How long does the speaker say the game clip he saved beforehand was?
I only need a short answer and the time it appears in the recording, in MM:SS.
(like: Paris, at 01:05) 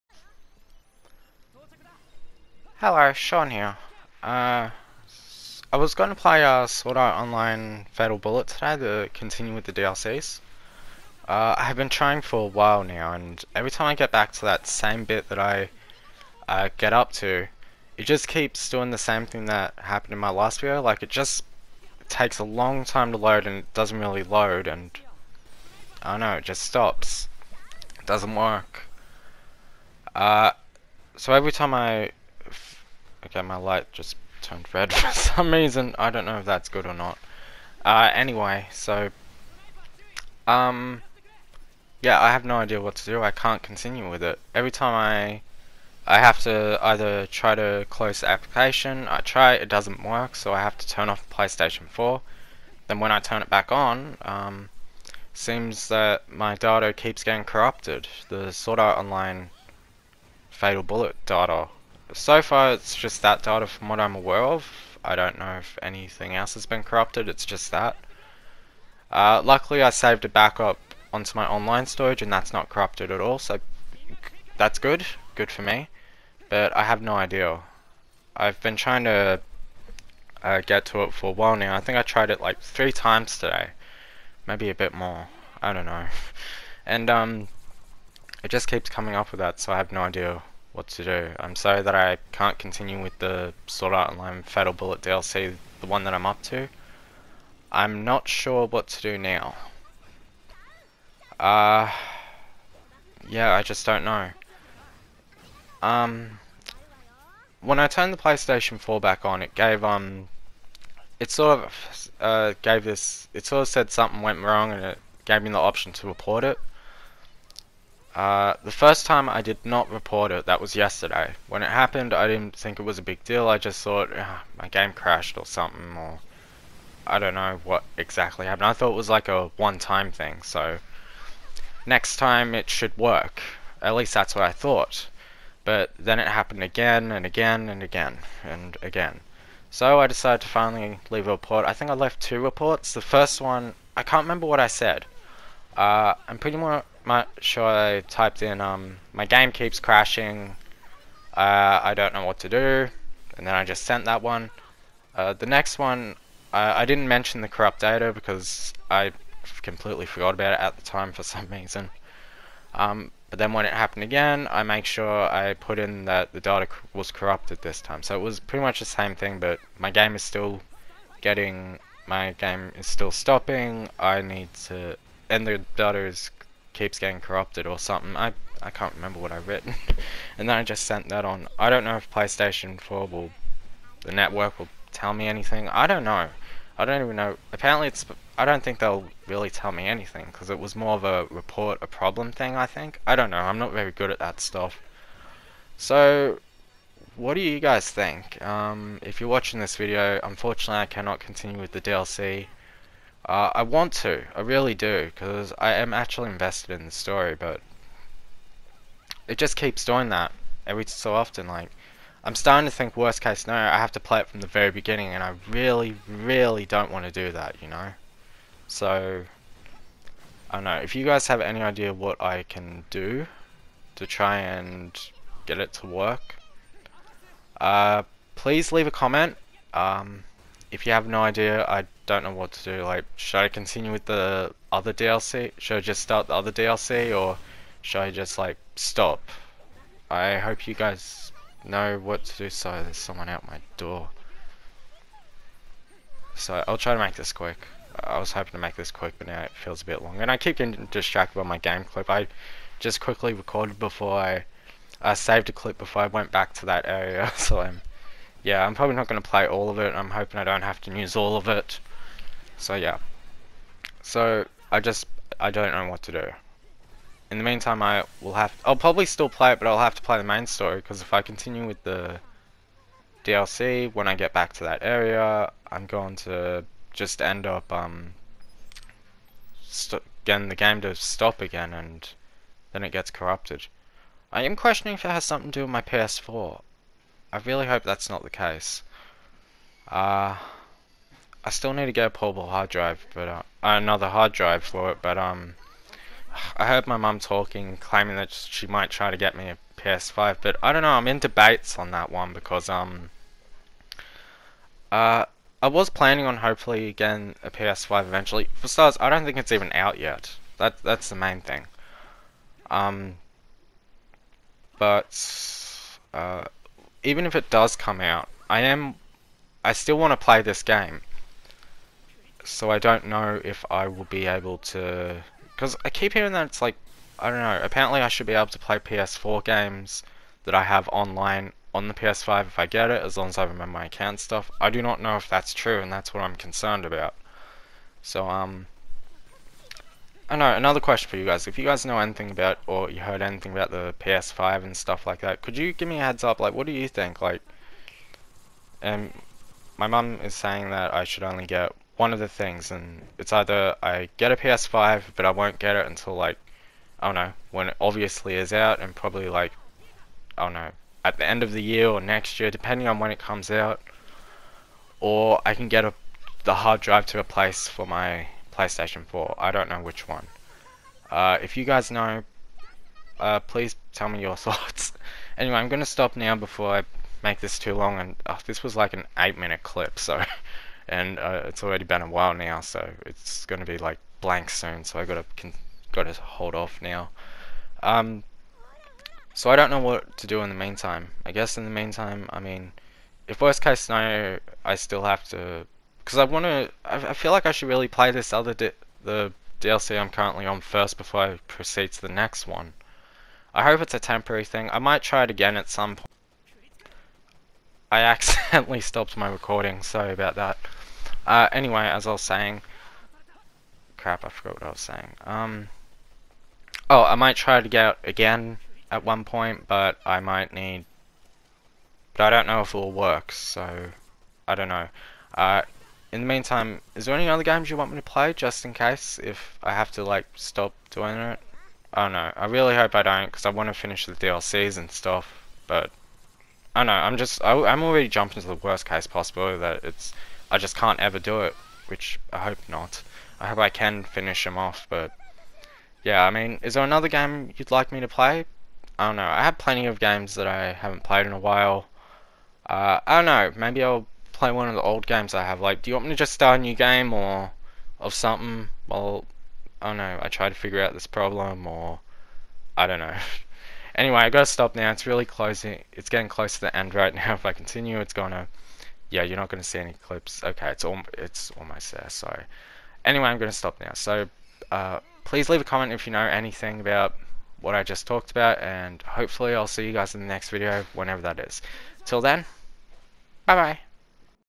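8 minutes, at 06:19.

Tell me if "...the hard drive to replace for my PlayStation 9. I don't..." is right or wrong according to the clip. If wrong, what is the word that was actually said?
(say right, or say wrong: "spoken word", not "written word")
wrong: "4", not "9".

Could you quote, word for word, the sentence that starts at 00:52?
Then when I turn it back on, um, seems that my data keeps getting corrupted.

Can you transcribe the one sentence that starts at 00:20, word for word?
Like, it just takes a long time to load, and it doesn't really load, and I don't know, it just stops.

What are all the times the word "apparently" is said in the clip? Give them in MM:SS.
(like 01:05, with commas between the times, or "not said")
03:07, 05:27.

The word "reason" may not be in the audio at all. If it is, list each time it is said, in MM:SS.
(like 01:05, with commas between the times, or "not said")
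00:35, 02:41.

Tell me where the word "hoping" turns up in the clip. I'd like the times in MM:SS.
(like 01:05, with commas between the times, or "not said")
04:08, 04:20.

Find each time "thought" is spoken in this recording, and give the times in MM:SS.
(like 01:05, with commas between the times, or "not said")
02:03, 02:08, 02:14, 06:14.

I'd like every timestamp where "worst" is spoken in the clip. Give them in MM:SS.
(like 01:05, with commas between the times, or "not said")
03:32, 06:33, 07:18.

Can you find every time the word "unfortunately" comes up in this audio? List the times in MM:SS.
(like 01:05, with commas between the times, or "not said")
03:20.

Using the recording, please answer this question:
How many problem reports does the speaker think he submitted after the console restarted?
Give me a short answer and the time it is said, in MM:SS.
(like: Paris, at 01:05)
2, at 02:22.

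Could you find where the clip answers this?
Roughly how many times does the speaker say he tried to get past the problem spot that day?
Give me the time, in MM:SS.
01:22.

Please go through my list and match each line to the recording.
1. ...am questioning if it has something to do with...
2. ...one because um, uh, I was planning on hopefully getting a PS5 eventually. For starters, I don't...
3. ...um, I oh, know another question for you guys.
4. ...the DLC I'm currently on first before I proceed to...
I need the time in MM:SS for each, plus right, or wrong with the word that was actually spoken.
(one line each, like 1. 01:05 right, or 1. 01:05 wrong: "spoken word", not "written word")
1. 04:44 right
2. 05:02 right
3. 05:38 right
4. 06:38 right.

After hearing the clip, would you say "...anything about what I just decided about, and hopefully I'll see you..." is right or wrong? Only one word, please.
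wrong.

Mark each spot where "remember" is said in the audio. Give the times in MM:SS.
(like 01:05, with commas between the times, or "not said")
02:24, 02:58, 05:33.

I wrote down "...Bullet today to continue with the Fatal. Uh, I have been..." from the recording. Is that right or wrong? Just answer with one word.
wrong.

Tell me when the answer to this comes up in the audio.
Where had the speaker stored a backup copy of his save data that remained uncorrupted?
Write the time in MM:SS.
01:11.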